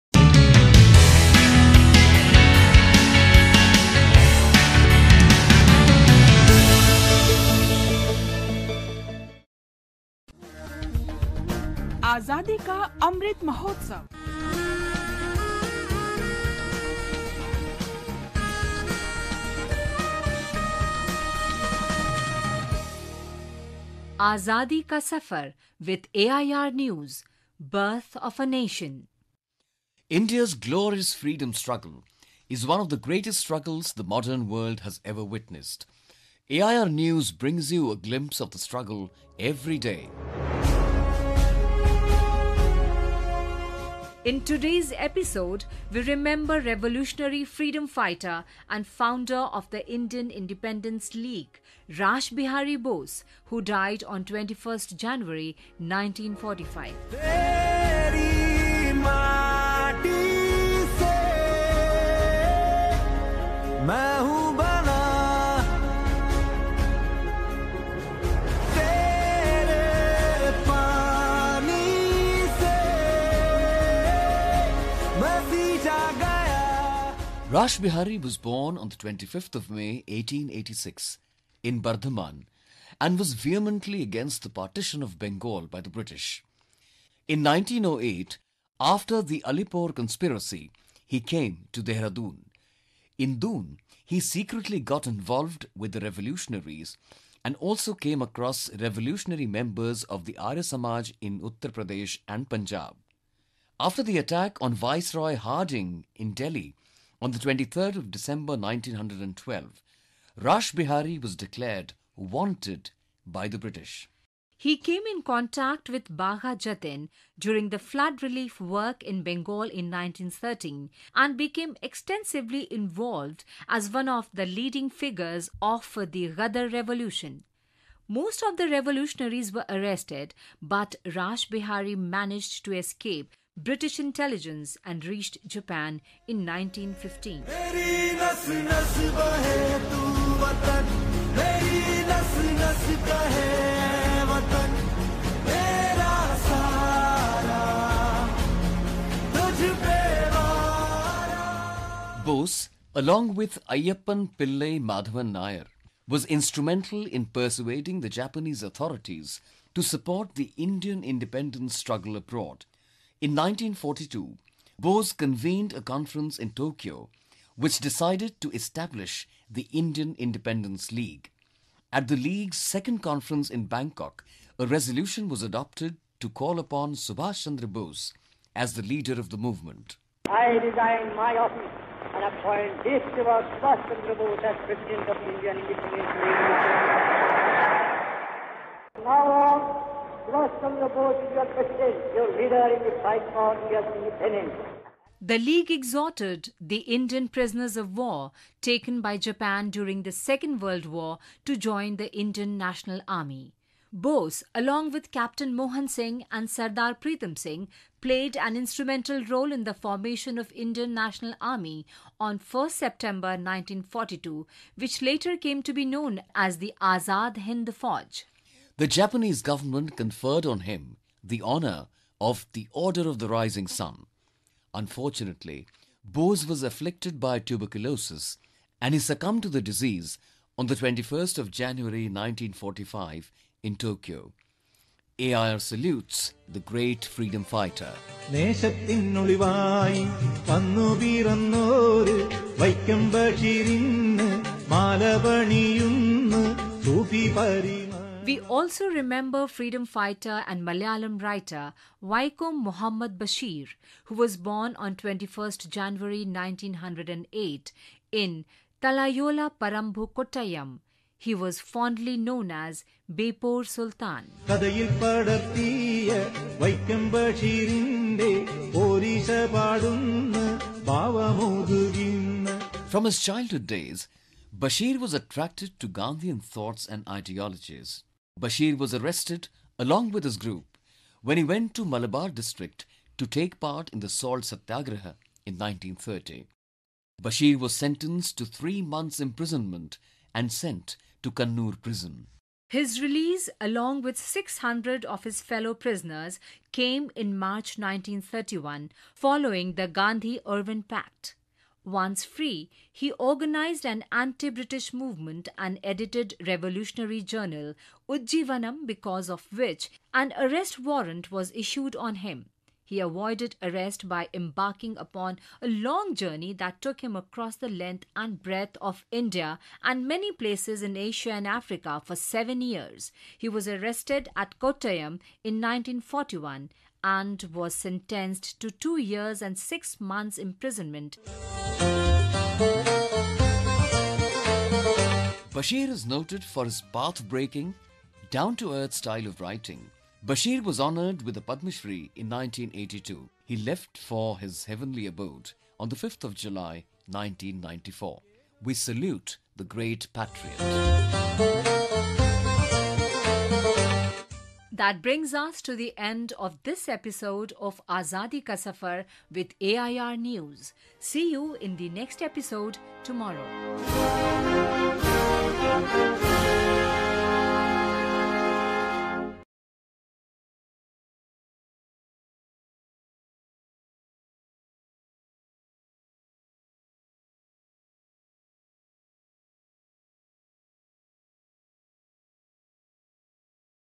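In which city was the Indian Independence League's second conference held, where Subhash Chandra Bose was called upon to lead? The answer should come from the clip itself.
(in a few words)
Bangkok.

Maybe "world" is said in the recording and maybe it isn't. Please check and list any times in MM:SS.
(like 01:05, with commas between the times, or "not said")
00:34, 03:20.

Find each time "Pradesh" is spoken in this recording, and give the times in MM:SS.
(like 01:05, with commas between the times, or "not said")
01:41.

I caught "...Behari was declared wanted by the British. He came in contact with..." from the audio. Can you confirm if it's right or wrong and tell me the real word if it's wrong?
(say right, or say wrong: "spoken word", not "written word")
right.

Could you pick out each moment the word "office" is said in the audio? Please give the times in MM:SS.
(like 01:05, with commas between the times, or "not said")
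03:01.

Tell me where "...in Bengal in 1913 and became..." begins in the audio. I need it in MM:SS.
01:59.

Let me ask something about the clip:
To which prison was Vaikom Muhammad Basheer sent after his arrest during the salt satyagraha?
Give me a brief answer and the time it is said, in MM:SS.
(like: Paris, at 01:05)
Kannur prison, at 04:51.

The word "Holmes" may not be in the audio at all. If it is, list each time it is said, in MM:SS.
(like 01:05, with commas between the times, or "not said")
not said.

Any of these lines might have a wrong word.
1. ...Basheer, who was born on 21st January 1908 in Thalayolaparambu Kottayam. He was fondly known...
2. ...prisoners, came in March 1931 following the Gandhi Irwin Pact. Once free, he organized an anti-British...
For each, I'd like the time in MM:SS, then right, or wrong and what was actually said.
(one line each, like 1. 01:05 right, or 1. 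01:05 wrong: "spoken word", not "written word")
1. 04:13 right
2. 04:55 right.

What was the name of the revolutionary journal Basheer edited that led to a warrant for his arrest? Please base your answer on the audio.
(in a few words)
Ujjeevanam.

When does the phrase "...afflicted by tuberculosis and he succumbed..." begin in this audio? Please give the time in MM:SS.
03:46.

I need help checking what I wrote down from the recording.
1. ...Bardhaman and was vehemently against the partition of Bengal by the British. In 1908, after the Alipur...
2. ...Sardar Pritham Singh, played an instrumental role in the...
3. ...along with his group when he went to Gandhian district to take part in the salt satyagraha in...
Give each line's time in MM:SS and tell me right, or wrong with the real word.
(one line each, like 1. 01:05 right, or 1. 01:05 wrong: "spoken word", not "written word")
1. 01:21 right
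2. 03:26 right
3. 04:39 wrong: "Malabar", not "Gandhian".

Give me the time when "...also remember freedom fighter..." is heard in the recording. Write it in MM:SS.
04:08.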